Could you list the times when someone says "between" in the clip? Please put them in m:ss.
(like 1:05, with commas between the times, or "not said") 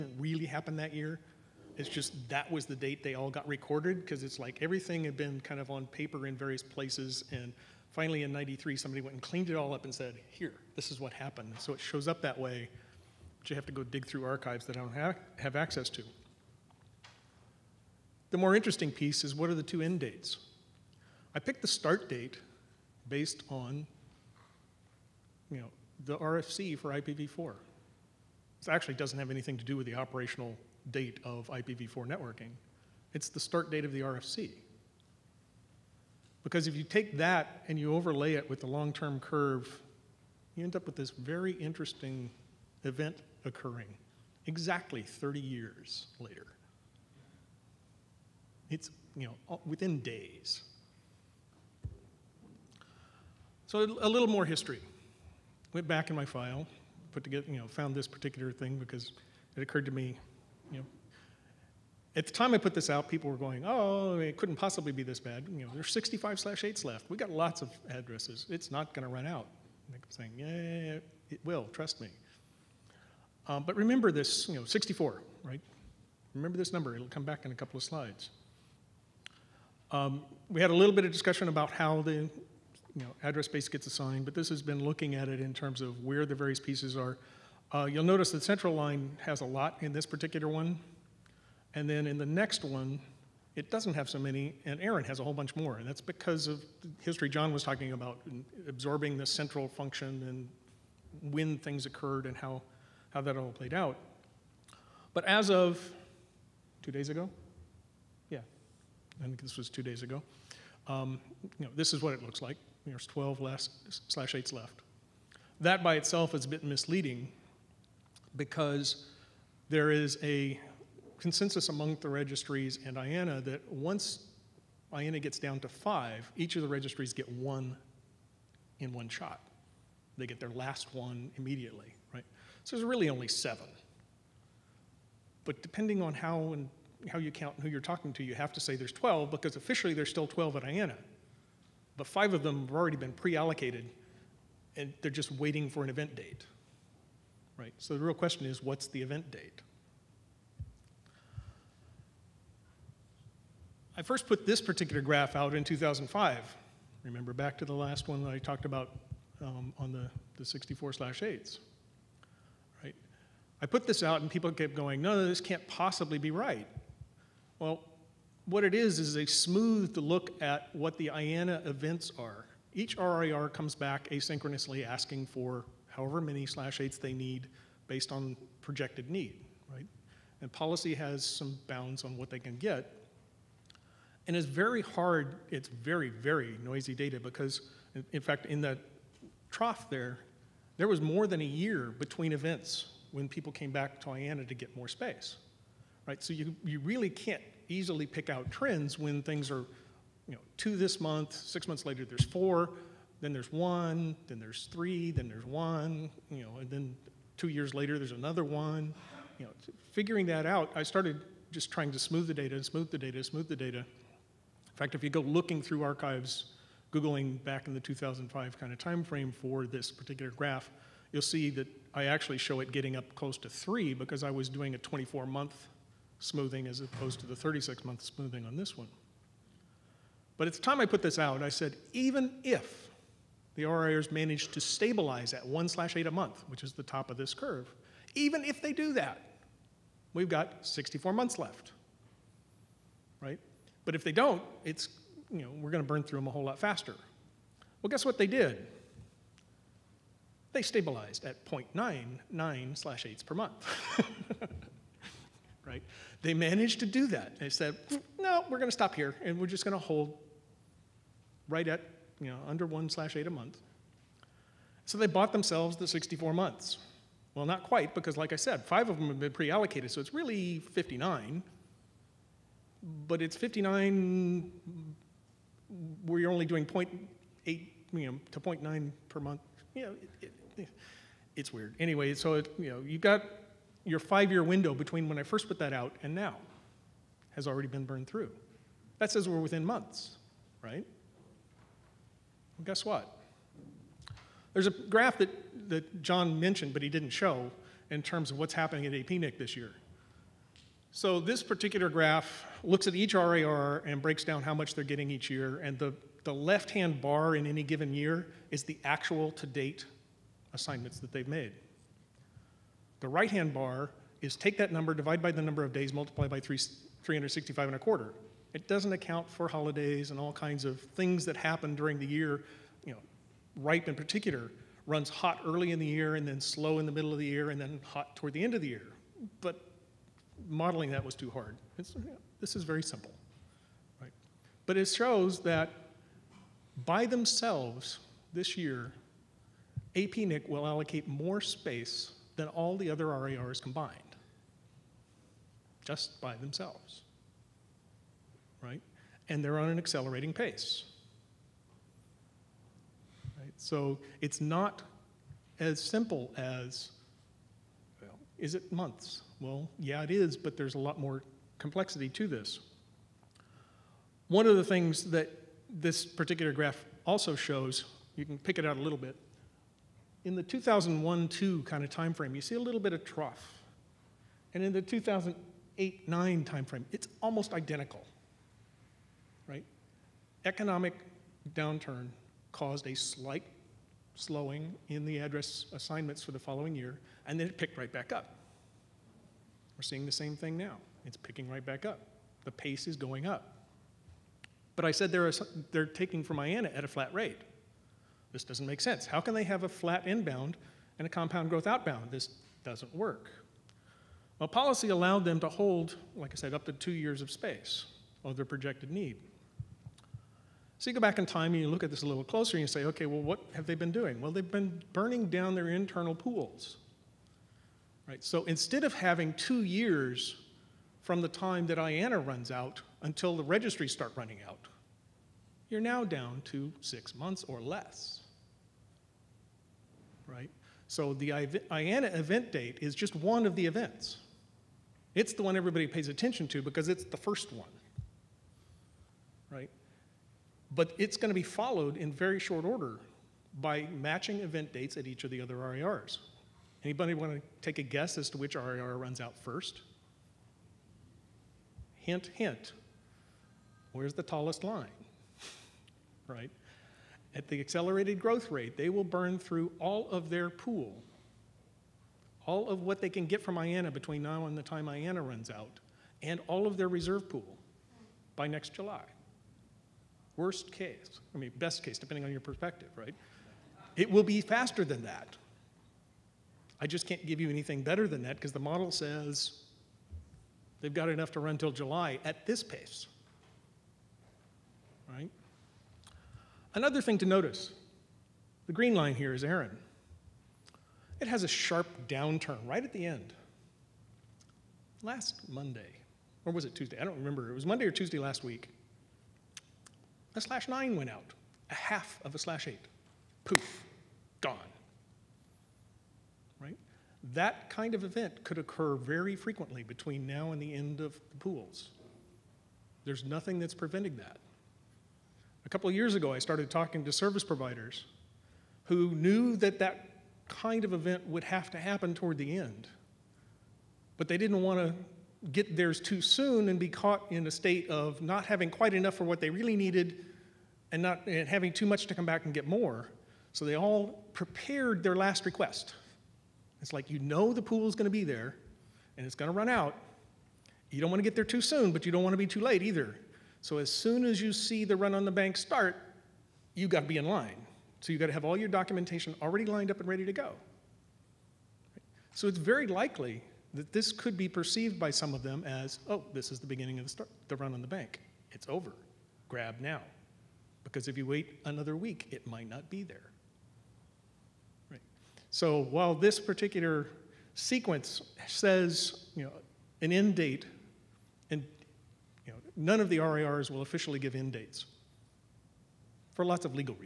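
3:11, 4:44, 7:43, 8:29.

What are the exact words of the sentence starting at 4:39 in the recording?
You know, it, it, it's weird.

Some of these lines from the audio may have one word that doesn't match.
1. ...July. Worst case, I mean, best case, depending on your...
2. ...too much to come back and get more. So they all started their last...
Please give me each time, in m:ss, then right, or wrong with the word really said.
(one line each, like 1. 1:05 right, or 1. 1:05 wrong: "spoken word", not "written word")
1. 7:48 right
2. 8:51 wrong: "prepared", not "started".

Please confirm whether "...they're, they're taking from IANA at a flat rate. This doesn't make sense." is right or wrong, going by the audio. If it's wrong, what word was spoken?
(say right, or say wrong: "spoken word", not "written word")
right.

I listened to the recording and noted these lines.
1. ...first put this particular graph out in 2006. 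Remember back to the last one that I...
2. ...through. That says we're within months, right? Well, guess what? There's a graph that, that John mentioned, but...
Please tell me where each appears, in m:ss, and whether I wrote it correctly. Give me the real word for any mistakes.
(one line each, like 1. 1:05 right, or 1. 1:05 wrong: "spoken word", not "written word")
1. 2:34 wrong: "2005", not "2006"
2. 4:48 right.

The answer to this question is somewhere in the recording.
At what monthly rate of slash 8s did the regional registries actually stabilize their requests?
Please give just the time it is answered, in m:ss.
4:11.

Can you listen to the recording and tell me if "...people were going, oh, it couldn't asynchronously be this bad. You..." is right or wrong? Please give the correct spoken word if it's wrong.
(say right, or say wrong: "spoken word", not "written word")
wrong: "possibly", not "asynchronously".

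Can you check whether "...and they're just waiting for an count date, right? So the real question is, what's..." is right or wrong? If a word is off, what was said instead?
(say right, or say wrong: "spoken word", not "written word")
wrong: "event", not "count".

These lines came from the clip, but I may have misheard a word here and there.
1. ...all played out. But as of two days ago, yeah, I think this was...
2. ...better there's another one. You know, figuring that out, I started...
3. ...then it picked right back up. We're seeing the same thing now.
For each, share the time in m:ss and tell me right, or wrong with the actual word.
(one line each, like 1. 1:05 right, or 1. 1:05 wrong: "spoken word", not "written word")
1. 1:43 right
2. 3:27 wrong: "later", not "better"
3. 6:27 right.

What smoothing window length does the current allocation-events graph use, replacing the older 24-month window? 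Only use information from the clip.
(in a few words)
36 months.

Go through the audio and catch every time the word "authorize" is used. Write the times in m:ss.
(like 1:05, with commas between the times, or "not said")
not said.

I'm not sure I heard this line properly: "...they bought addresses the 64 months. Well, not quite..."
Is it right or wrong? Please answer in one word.
wrong.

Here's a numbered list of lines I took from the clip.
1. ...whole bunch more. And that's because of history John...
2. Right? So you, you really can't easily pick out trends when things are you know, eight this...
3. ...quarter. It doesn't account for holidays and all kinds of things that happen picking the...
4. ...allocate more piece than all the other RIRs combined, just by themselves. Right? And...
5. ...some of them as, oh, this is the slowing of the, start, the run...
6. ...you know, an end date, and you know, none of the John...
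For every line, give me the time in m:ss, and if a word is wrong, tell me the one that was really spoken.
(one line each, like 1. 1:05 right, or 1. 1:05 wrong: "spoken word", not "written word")
1. 1:35 right
2. 3:16 wrong: "two", not "eight"
3. 5:17 wrong: "during", not "picking"
4. 5:40 wrong: "space", not "piece"
5. 9:15 wrong: "beginning", not "slowing"
6. 9:29 wrong: "RIRs", not "John".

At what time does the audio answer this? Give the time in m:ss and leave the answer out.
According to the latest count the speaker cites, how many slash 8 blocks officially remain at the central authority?
1:52.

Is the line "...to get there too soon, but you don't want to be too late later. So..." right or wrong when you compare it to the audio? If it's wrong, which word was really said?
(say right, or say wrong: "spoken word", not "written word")
wrong: "either", not "later".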